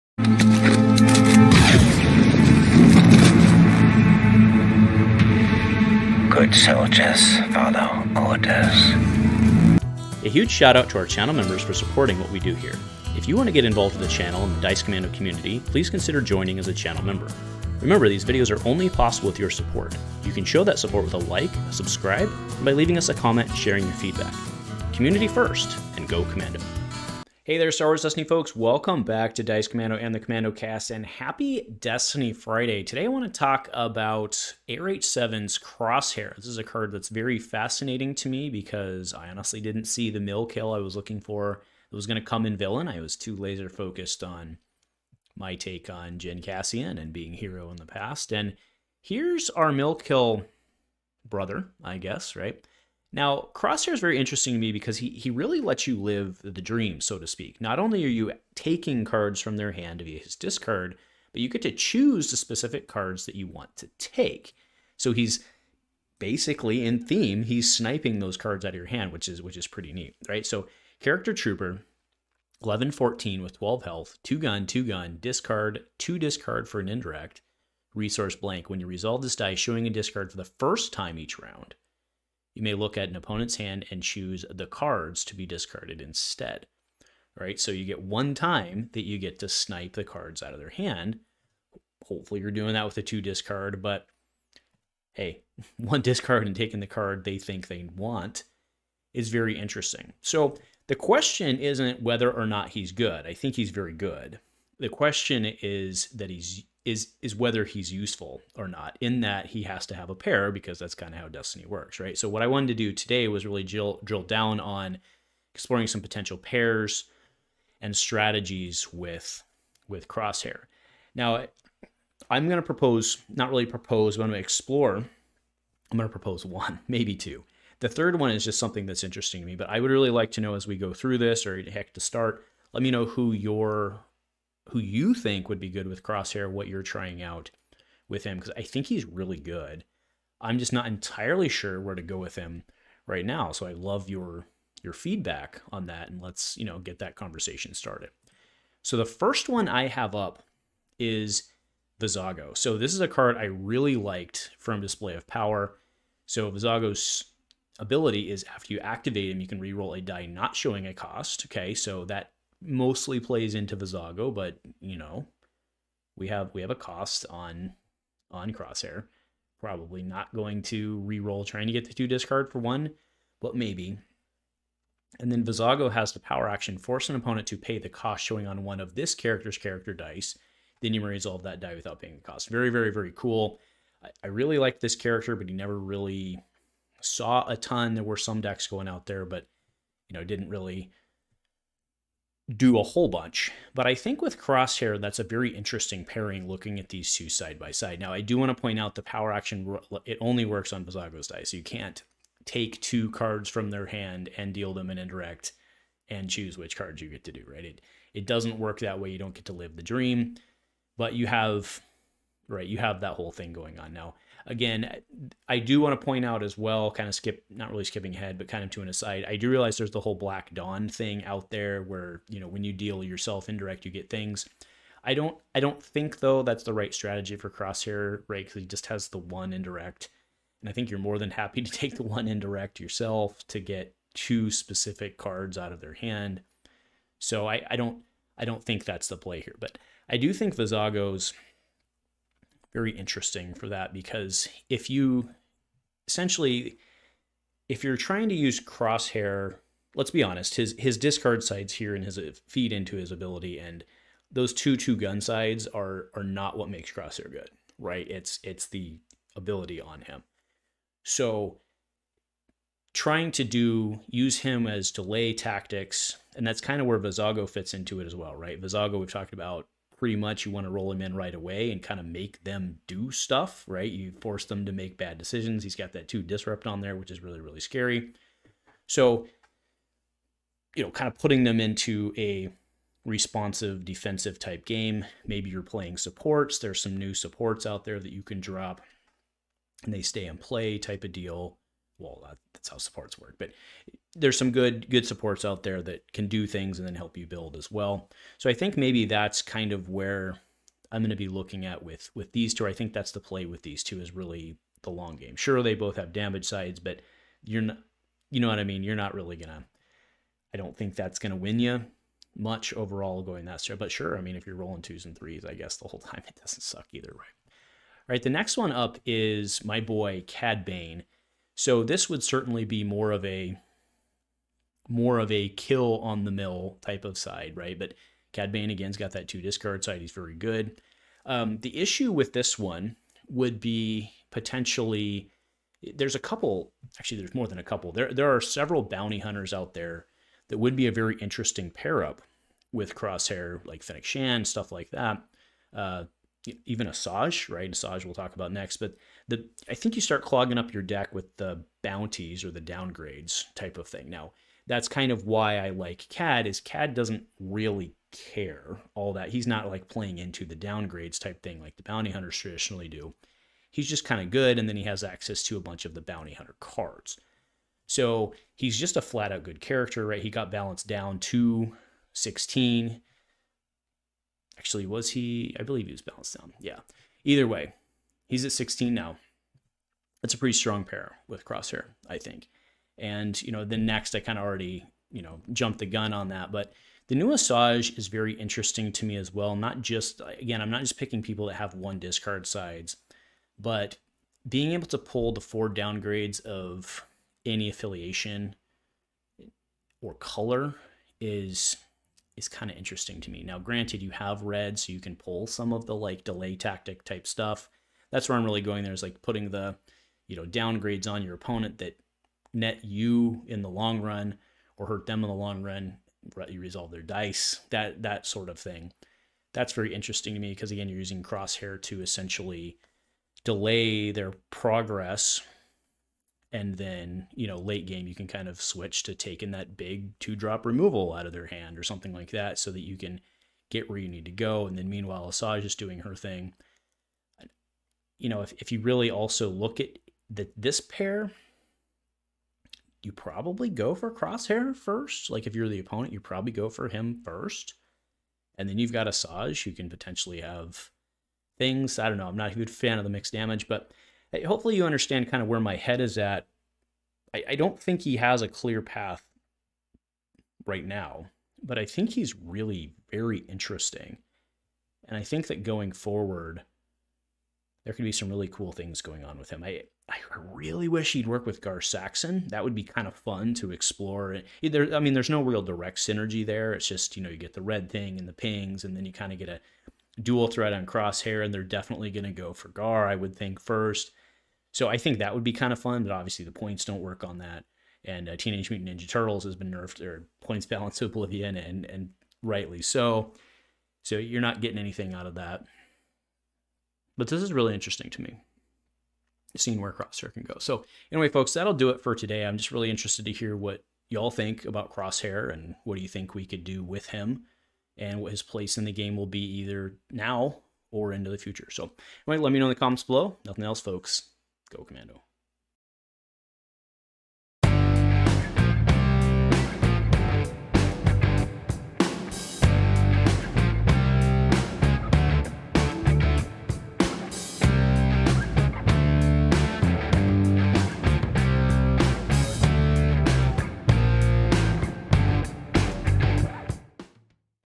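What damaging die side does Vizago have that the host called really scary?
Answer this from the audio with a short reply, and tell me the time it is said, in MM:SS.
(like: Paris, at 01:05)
two disrupt, at 04:36.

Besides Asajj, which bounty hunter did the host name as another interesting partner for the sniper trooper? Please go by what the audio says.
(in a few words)
Fennec Shand.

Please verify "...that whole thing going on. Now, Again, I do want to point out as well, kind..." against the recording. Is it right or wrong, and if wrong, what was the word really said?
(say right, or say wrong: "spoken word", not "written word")
right.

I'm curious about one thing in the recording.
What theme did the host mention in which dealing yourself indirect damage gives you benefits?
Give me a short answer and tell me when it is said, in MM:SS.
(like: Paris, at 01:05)
Black Dawn, at 03:40.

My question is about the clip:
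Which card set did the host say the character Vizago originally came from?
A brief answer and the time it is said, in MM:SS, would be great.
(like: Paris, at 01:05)
Display of Power, at 02:34.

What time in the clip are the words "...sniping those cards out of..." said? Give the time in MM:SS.
01:07.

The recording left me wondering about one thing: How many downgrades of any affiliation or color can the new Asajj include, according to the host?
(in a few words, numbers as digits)
4.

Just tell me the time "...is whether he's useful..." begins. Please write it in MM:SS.
01:47.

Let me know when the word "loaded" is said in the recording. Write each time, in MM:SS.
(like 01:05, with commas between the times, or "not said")
not said.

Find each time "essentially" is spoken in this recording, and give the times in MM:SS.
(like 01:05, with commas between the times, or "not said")
04:06, 07:02.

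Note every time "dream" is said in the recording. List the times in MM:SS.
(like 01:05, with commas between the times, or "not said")
00:56, 03:29.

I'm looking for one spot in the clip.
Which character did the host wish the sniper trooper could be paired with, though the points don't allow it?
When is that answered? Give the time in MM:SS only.
07:51.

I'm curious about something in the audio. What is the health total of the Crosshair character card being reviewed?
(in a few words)
12.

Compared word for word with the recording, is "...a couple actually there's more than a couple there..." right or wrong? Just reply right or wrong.
right.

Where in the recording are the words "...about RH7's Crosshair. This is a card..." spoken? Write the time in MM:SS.
00:33.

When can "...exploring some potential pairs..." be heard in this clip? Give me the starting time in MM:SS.
01:55.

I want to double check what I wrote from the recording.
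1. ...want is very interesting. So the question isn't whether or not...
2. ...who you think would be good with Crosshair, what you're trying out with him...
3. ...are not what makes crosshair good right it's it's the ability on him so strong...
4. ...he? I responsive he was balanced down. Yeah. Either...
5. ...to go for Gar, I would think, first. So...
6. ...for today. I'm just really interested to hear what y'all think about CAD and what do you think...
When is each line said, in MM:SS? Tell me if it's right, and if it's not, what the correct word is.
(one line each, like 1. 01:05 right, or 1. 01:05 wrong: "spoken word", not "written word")
1. 01:37 right
2. 02:14 right
3. 04:16 wrong: "trying", not "strong"
4. 06:15 wrong: "believe", not "responsive"
5. 08:02 right
6. 08:22 wrong: "Crosshair", not "CAD".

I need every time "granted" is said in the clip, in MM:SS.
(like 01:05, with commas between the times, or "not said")
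06:43.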